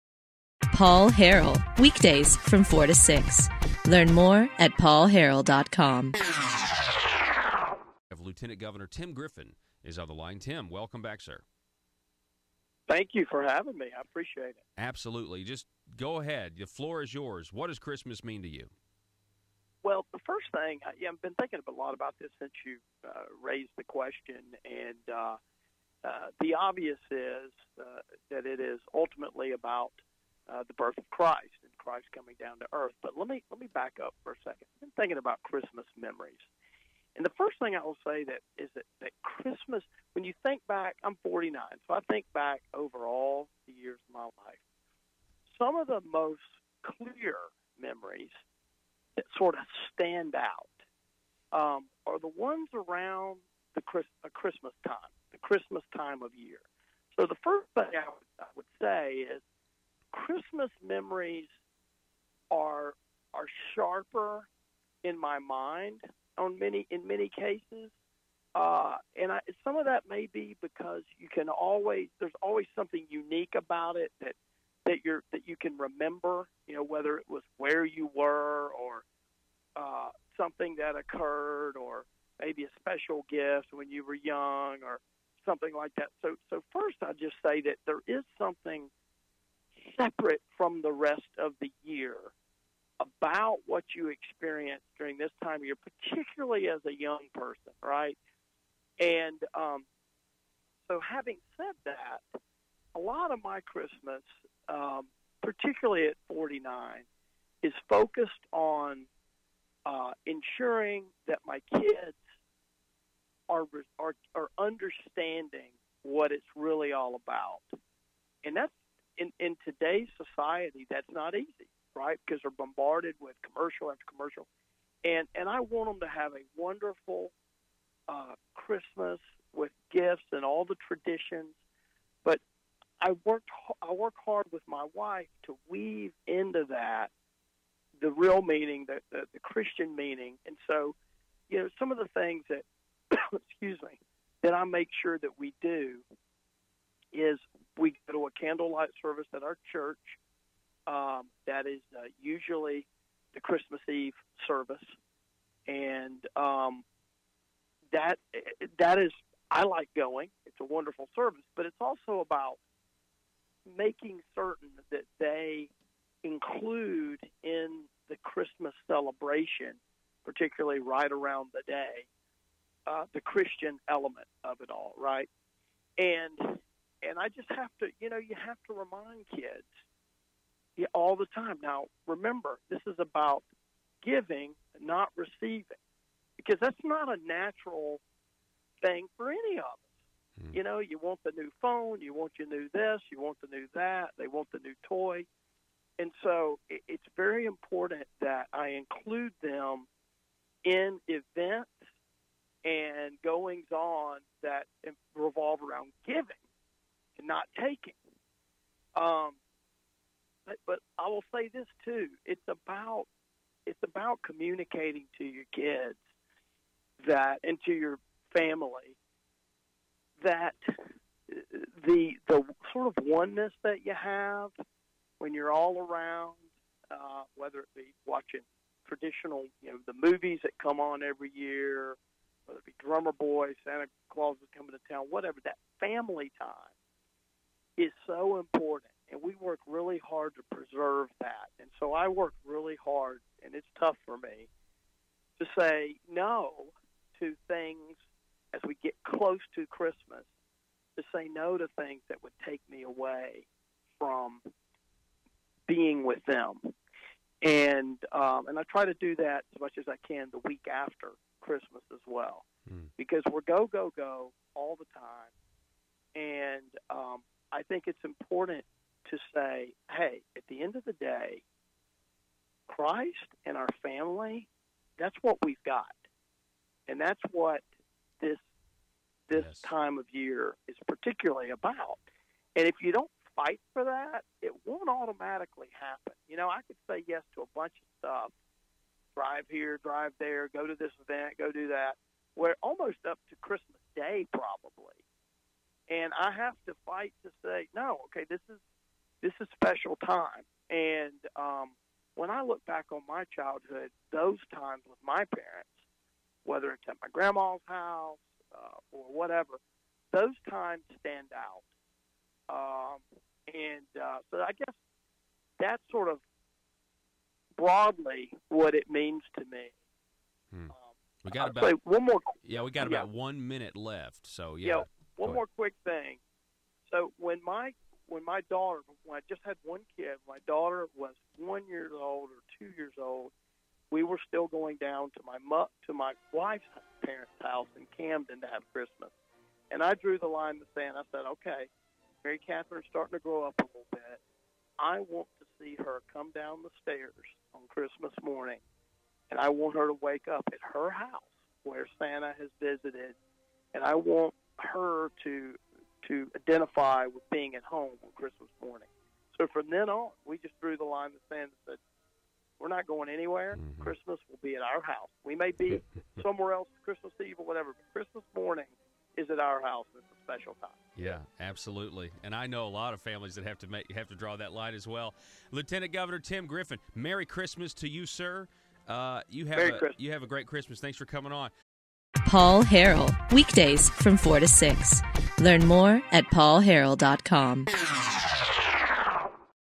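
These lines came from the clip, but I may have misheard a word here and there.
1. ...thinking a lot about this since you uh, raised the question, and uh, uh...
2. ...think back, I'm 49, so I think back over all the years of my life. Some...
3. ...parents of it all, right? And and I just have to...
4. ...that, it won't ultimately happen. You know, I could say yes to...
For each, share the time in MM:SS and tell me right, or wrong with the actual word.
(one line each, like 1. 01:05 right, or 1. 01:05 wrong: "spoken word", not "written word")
1. 00:21 right
2. 00:40 right
3. 02:53 wrong: "element", not "parents"
4. 04:43 wrong: "automatically", not "ultimately".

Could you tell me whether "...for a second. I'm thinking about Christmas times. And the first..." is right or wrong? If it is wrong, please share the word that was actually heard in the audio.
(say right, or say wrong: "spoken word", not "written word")
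wrong: "memories", not "times".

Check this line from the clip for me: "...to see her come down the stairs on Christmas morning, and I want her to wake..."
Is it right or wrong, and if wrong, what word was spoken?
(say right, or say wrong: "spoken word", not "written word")
right.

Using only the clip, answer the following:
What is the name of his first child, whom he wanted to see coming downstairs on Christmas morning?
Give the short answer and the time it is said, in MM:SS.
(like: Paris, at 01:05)
Mary Catherine, at 05:42.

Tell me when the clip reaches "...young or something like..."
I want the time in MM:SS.
01:24.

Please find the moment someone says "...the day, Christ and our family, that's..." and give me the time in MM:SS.
04:30.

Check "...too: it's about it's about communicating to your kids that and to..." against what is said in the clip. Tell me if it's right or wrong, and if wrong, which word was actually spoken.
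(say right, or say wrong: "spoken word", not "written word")
right.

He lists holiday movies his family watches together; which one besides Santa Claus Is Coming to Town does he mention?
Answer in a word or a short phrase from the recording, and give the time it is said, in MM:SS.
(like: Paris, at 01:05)
Drummer Boy, at 03:52.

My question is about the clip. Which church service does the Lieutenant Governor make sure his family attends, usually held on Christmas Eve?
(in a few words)
candlelight service.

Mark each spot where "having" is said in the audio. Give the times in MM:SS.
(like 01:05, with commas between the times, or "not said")
00:13, 01:41.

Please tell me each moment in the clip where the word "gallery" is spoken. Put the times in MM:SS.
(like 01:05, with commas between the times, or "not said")
not said.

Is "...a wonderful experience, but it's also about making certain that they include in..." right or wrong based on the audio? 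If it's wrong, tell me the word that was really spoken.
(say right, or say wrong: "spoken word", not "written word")
wrong: "service", not "experience".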